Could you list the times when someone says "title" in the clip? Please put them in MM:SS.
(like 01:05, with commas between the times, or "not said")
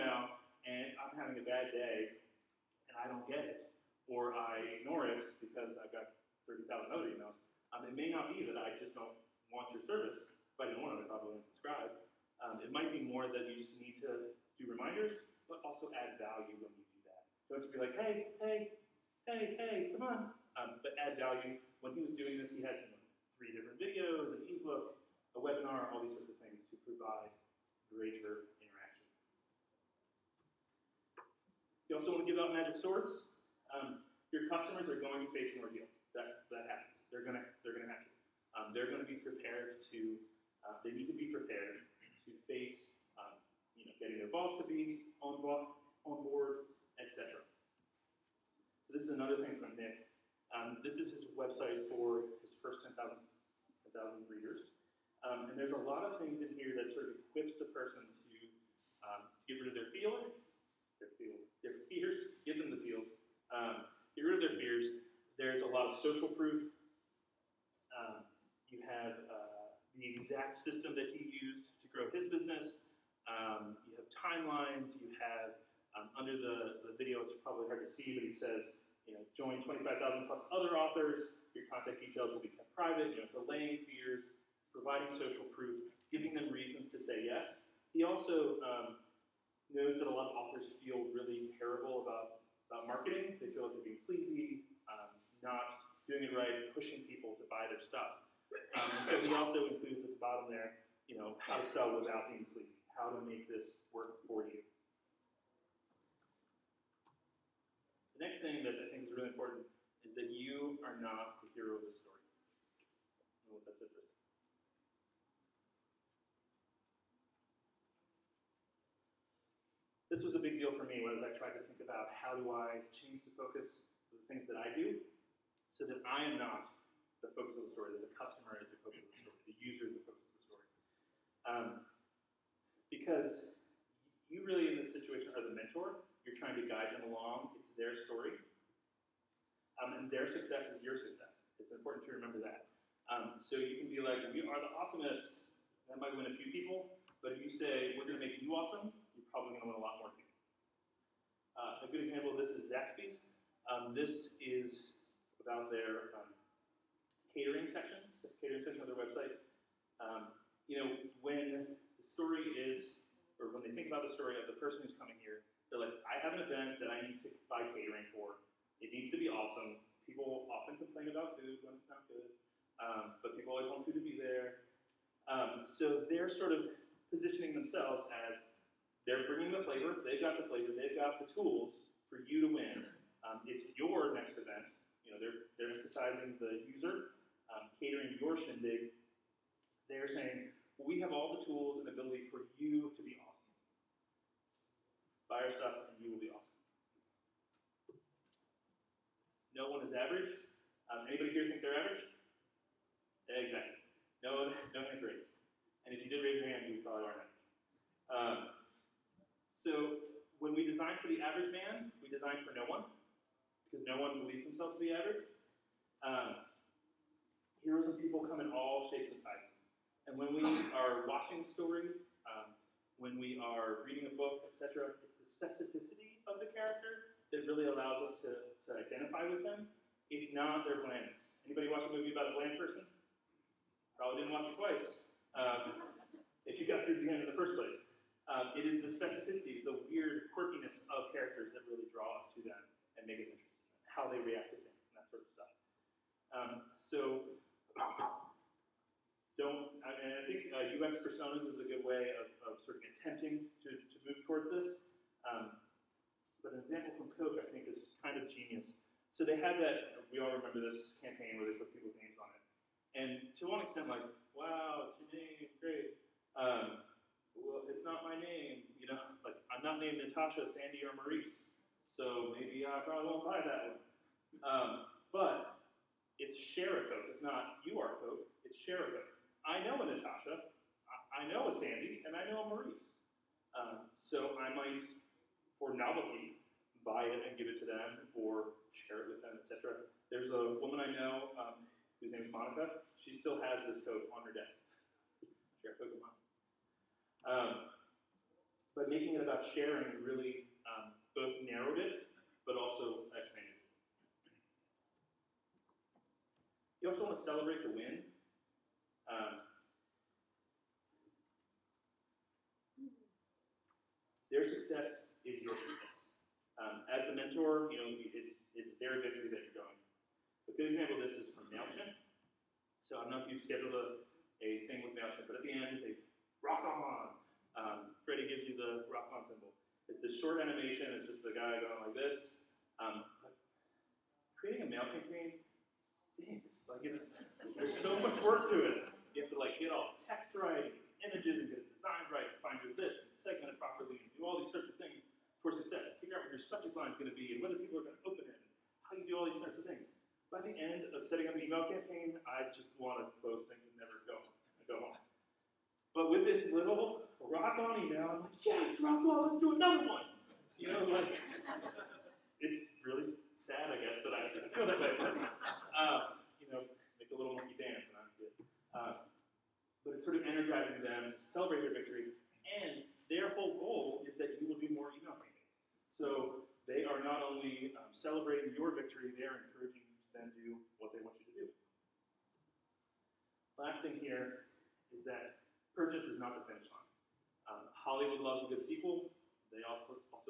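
not said.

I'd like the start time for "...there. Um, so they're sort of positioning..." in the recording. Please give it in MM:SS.
02:54.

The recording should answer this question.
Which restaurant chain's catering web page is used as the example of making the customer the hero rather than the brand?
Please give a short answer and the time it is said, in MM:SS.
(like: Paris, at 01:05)
Zaxby's, at 02:32.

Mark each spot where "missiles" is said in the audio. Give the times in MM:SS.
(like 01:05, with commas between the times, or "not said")
not said.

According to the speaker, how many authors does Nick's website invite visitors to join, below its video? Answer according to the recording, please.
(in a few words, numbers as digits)
25,000.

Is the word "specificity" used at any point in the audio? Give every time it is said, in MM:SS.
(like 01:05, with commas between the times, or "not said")
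03:45, 03:58.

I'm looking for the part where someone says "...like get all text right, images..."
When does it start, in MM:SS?
05:39.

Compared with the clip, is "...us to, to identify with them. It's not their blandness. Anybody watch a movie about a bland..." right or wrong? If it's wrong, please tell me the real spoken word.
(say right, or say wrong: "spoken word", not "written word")
right.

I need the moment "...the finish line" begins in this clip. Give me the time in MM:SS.
06:26.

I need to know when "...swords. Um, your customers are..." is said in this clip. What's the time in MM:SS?
00:32.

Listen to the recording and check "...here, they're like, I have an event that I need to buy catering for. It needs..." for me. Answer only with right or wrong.
right.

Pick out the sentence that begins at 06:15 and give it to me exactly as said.
So are not only um, celebrating your victory, they are encouraging you to then do what they want you to do.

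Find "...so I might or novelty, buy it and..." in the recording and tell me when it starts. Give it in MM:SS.
04:43.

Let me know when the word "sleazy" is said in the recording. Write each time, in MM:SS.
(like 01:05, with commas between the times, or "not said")
01:33, 01:42.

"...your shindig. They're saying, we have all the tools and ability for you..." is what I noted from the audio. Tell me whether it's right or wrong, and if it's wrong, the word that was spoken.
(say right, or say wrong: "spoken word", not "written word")
right.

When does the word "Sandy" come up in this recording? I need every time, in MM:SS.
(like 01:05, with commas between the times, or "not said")
04:30, 04:41.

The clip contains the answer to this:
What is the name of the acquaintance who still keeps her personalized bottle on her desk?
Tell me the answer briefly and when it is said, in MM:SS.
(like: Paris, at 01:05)
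Monica, at 04:52.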